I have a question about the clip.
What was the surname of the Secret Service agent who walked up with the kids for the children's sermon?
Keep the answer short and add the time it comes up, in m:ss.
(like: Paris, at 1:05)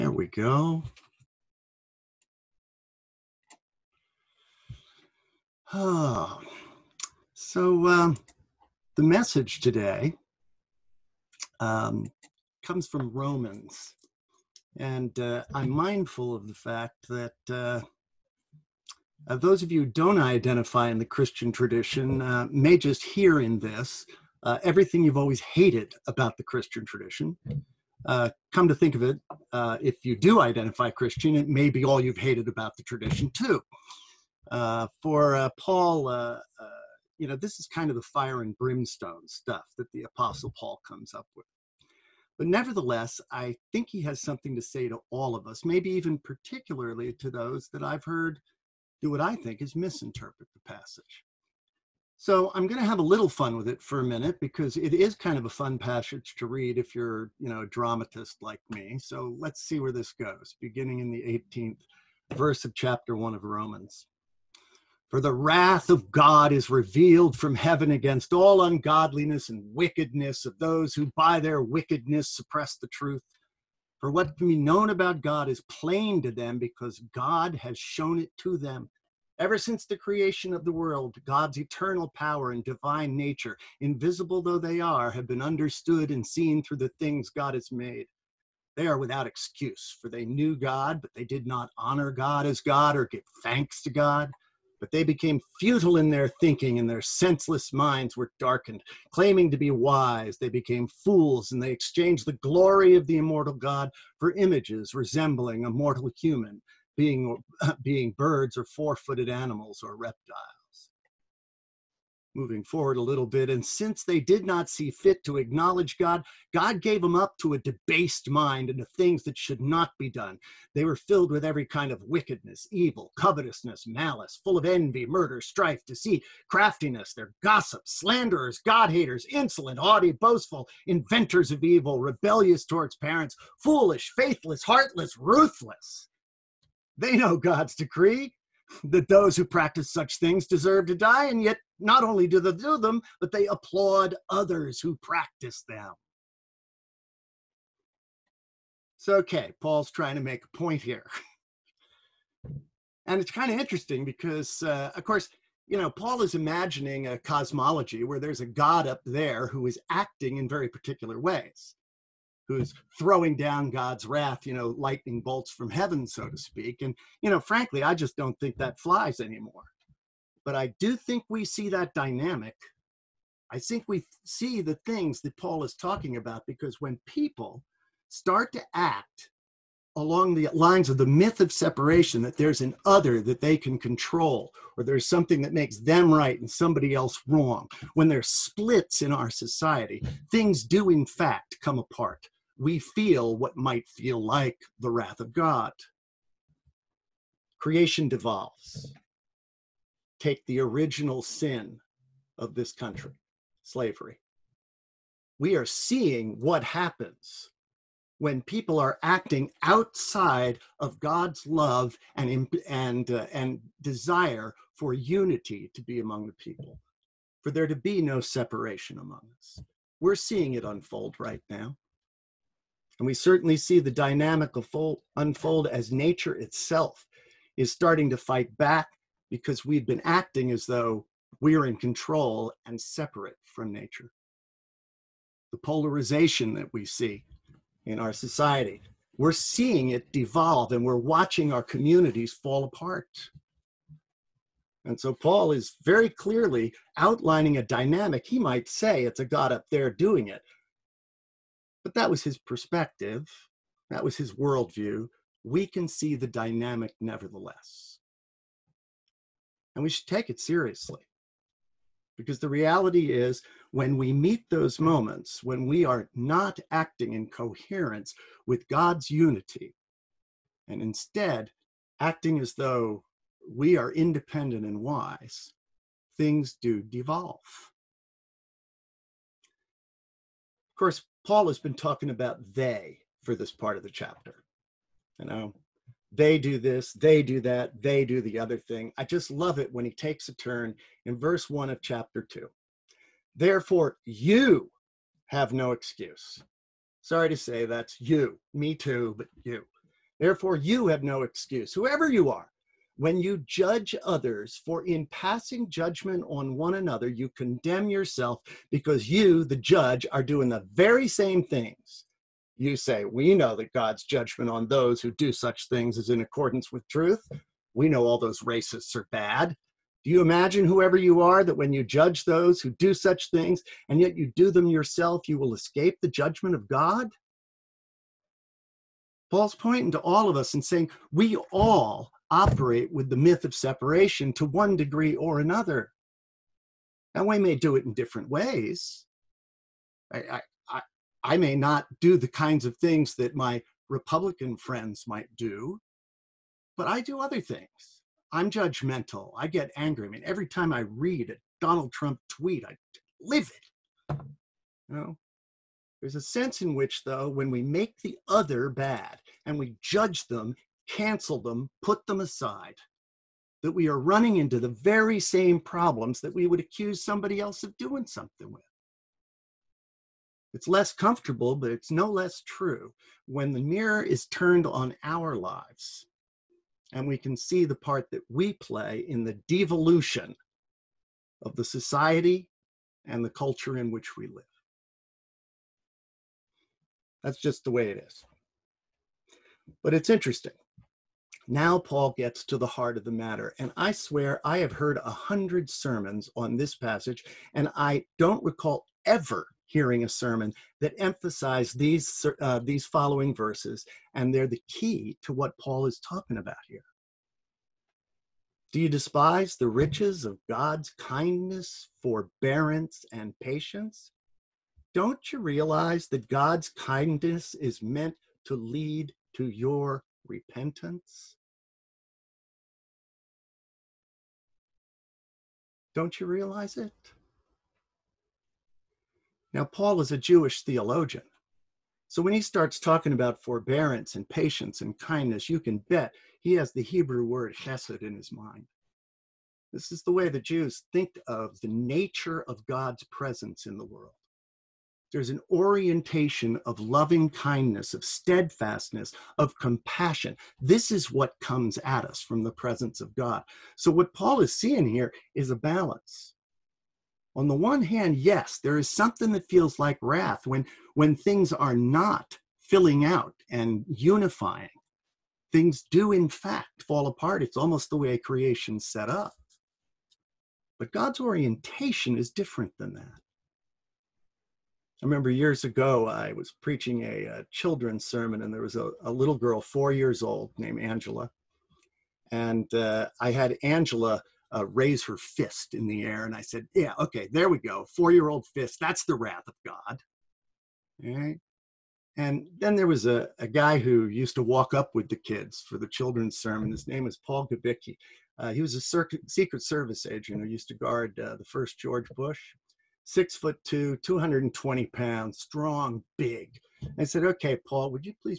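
Gabicki, at 8:17.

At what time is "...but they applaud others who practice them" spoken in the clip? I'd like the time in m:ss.
2:23.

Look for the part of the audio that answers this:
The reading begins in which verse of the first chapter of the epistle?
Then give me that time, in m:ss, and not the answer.
1:01.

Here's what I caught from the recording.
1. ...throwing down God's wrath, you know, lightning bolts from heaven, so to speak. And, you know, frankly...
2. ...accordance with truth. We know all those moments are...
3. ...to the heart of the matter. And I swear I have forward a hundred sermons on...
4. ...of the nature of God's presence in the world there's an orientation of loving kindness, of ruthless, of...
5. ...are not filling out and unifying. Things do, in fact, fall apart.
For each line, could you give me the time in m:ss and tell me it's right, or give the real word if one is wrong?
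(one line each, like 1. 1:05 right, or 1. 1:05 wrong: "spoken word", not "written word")
1. 2:42 right
2. 5:16 wrong: "racists", not "moments"
3. 6:32 wrong: "heard", not "forward"
4. 7:21 wrong: "steadfastness", not "ruthless"
5. 7:41 right.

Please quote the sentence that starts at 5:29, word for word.
Paul's pointing to all of us and saying, we all operate with the myth of separation to one degree or another.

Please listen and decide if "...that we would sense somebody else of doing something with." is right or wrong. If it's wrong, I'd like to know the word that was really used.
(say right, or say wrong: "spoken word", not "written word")
wrong: "accuse", not "sense".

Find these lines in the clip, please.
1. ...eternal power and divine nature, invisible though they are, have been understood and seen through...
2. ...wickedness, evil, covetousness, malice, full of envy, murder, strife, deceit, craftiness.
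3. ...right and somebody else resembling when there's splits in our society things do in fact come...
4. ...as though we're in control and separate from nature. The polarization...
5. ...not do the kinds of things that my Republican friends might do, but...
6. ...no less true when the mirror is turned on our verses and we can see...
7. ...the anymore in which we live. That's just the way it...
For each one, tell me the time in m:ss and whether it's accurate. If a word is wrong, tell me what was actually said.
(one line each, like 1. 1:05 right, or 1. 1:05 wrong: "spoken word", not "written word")
1. 1:21 right
2. 2:02 right
3. 3:06 wrong: "wrong", not "resembling"
4. 3:50 right
5. 5:41 right
6. 6:11 wrong: "lives", not "verses"
7. 6:23 wrong: "culture", not "anymore".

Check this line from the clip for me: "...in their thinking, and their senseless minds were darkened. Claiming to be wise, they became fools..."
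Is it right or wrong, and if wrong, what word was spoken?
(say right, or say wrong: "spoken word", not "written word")
right.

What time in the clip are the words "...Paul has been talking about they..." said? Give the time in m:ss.
4:41.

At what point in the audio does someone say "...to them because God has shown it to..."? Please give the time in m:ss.
1:16.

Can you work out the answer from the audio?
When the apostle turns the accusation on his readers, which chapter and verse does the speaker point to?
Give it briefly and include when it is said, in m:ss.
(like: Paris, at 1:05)
verse 1 of chapter 2, at 4:51.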